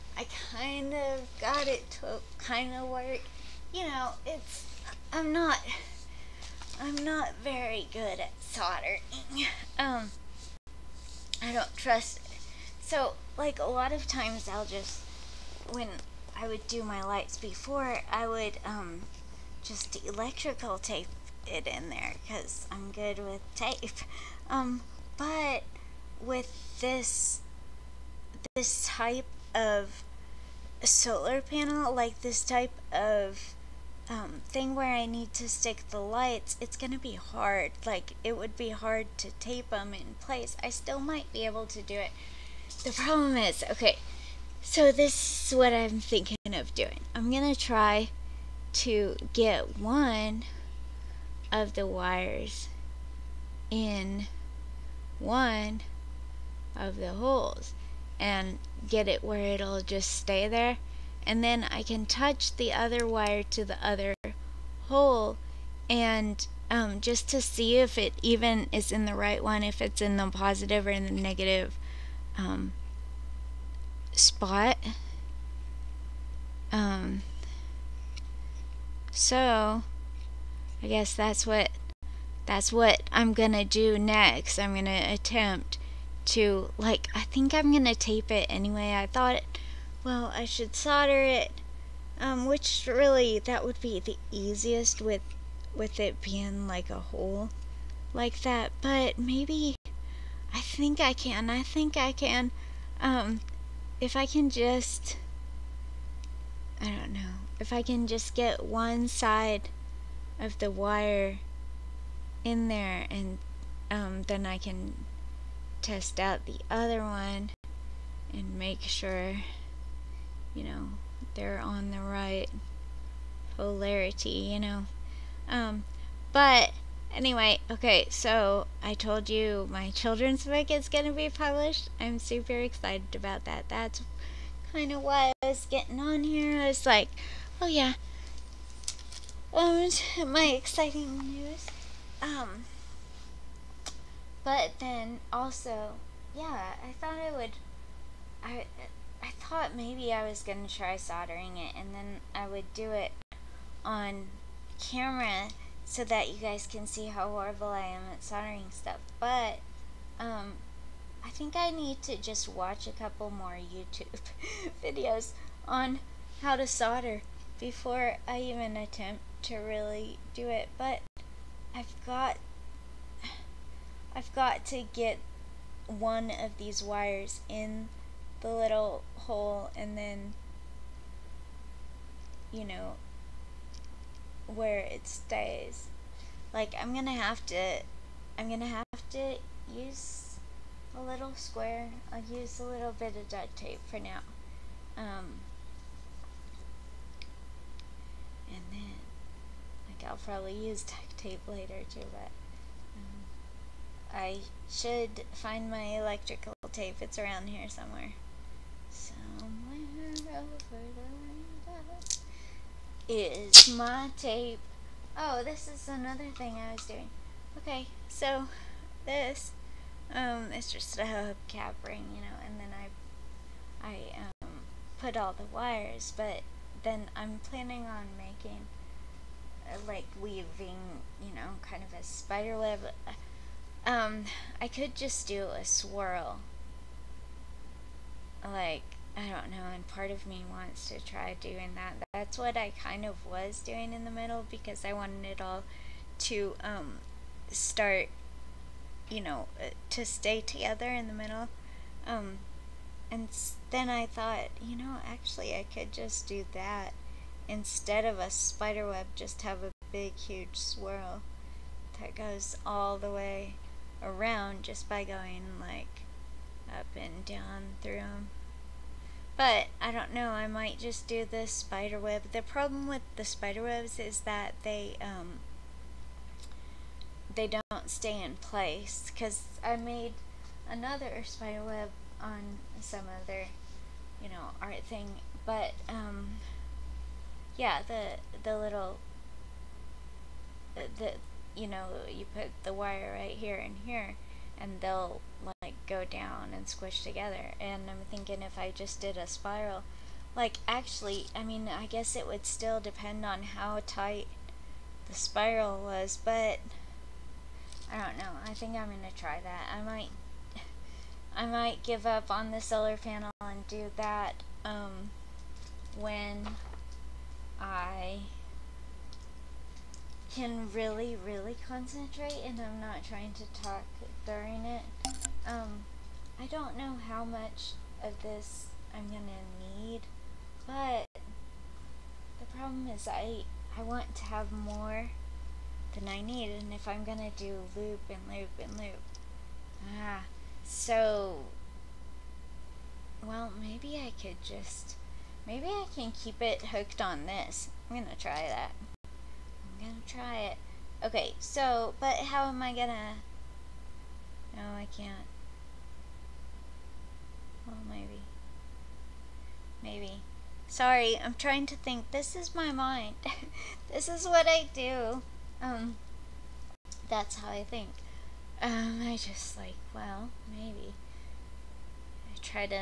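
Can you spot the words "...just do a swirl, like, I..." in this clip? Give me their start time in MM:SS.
03:54.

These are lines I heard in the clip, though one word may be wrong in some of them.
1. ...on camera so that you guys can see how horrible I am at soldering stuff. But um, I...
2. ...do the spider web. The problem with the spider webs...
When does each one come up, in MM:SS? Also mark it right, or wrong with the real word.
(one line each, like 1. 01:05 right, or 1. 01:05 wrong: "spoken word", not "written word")
1. 02:33 right
2. 04:31 right.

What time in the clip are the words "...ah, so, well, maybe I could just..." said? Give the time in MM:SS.
05:40.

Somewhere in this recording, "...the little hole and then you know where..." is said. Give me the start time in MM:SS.
02:58.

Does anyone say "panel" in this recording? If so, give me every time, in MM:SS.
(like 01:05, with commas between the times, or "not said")
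00:31, 05:12.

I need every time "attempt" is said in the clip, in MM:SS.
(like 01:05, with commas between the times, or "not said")
01:25, 02:48.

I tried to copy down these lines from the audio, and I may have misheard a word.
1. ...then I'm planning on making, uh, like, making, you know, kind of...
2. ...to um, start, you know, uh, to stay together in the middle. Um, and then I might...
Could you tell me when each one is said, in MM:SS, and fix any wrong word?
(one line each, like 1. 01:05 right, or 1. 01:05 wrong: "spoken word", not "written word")
1. 03:46 wrong: "weaving", not "making"
2. 04:06 wrong: "thought", not "might".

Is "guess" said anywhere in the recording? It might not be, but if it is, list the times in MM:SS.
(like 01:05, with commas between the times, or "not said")
01:20, 05:01.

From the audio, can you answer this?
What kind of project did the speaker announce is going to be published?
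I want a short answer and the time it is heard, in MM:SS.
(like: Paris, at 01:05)
children's book, at 02:09.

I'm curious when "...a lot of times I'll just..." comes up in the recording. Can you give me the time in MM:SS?
00:13.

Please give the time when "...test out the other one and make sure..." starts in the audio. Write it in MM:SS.
01:55.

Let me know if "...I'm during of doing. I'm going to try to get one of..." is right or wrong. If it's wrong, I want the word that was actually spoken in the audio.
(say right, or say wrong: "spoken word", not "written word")
wrong: "thinking", not "during".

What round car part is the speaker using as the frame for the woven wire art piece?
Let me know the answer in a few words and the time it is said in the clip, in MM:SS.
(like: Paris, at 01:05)
hubcap ring, at 03:41.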